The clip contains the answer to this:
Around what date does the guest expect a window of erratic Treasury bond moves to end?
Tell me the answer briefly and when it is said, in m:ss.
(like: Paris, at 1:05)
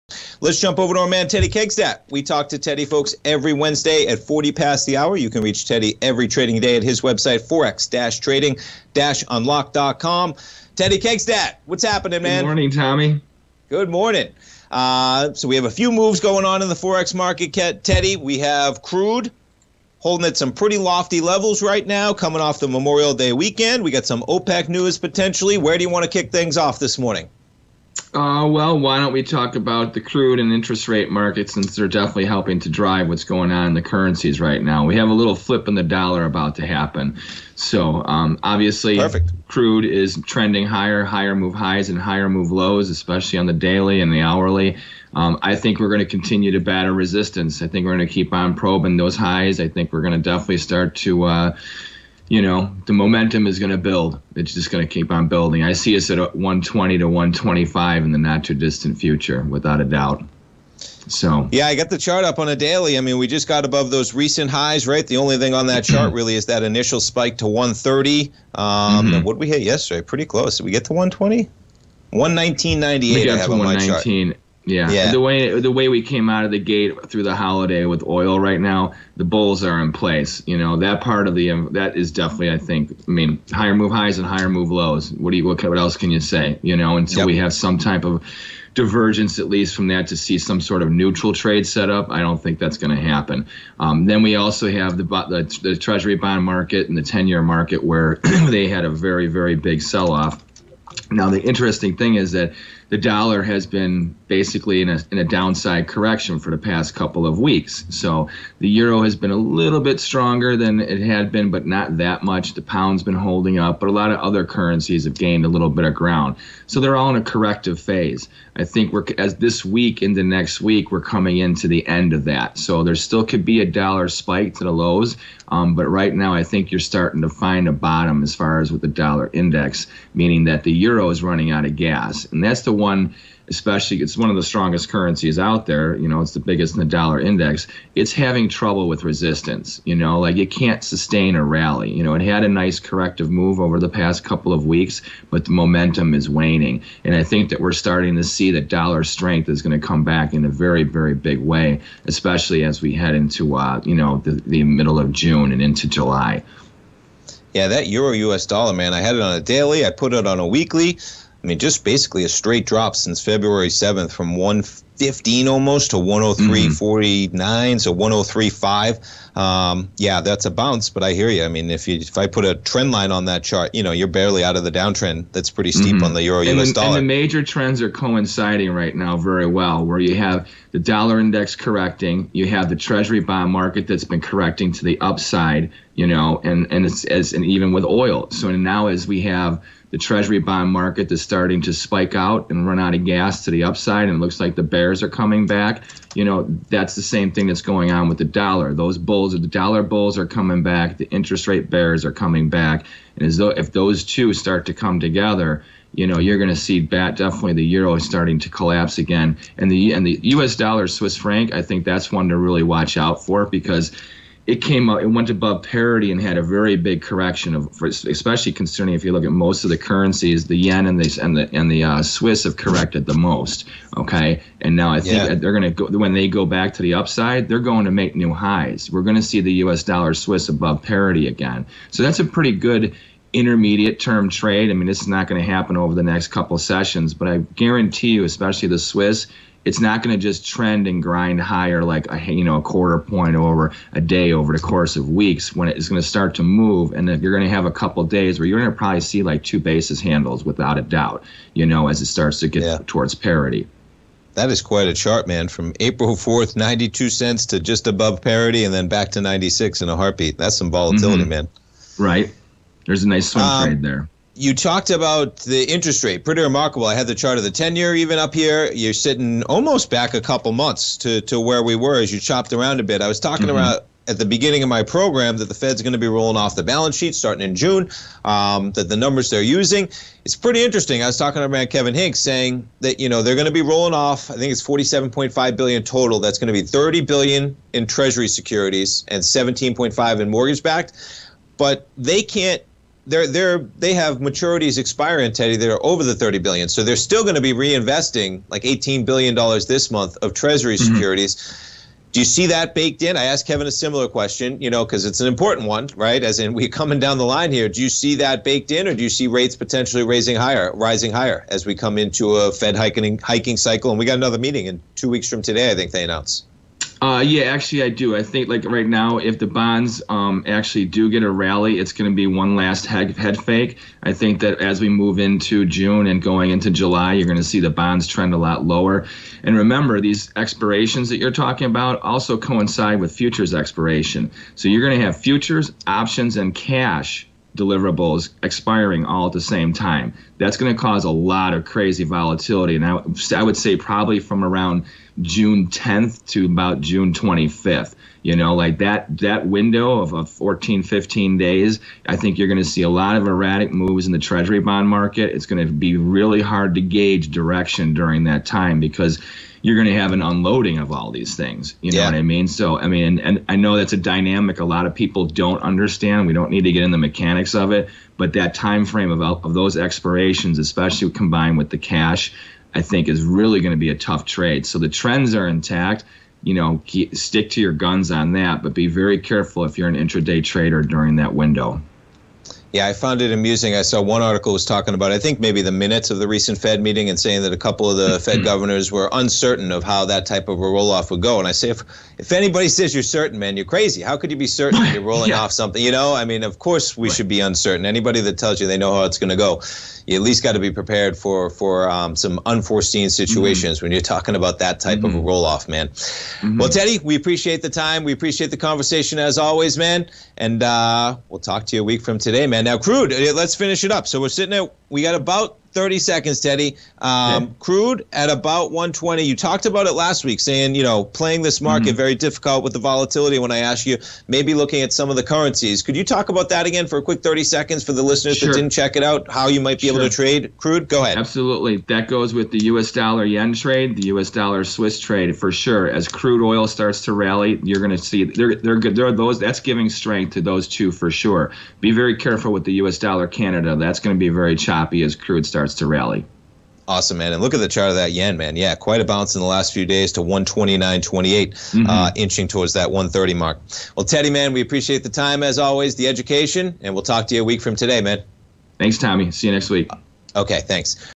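June 25th, at 5:46.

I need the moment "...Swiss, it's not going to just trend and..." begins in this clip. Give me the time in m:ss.
3:58.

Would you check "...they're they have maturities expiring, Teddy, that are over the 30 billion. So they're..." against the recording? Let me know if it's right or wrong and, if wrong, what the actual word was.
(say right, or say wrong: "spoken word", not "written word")
right.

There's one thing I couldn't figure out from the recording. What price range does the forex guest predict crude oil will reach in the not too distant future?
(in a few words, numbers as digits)
120 to 125.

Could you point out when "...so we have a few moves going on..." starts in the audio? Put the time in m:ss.
0:15.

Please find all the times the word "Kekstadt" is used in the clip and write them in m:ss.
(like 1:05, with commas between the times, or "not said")
0:01, 0:10.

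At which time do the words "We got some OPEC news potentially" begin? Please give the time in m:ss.
0:23.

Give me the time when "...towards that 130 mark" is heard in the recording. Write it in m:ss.
7:32.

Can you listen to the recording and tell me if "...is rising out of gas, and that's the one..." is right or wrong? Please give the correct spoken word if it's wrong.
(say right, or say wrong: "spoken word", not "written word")
wrong: "running", not "rising".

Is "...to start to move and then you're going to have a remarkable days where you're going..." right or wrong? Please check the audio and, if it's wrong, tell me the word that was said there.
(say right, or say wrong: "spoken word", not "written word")
wrong: "couple", not "remarkable".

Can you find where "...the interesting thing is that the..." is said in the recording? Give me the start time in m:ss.
1:41.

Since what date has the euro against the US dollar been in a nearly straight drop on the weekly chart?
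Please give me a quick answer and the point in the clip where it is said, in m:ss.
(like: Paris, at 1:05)
February 7th, at 2:43.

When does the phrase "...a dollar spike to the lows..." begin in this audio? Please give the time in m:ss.
2:03.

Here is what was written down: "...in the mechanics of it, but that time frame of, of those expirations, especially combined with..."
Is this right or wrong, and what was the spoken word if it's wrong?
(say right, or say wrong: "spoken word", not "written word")
right.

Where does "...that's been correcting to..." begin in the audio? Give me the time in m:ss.
3:03.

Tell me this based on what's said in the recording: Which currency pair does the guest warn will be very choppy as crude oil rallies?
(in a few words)
US dollar Canada.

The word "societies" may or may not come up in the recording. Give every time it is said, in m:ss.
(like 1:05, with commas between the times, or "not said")
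not said.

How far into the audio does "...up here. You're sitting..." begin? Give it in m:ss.
4:28.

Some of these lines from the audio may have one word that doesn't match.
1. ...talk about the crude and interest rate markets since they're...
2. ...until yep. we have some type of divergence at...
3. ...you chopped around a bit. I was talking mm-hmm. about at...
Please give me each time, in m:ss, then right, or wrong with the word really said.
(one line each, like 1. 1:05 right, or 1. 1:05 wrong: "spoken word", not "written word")
1. 0:29 right
2. 1:26 right
3. 4:32 right.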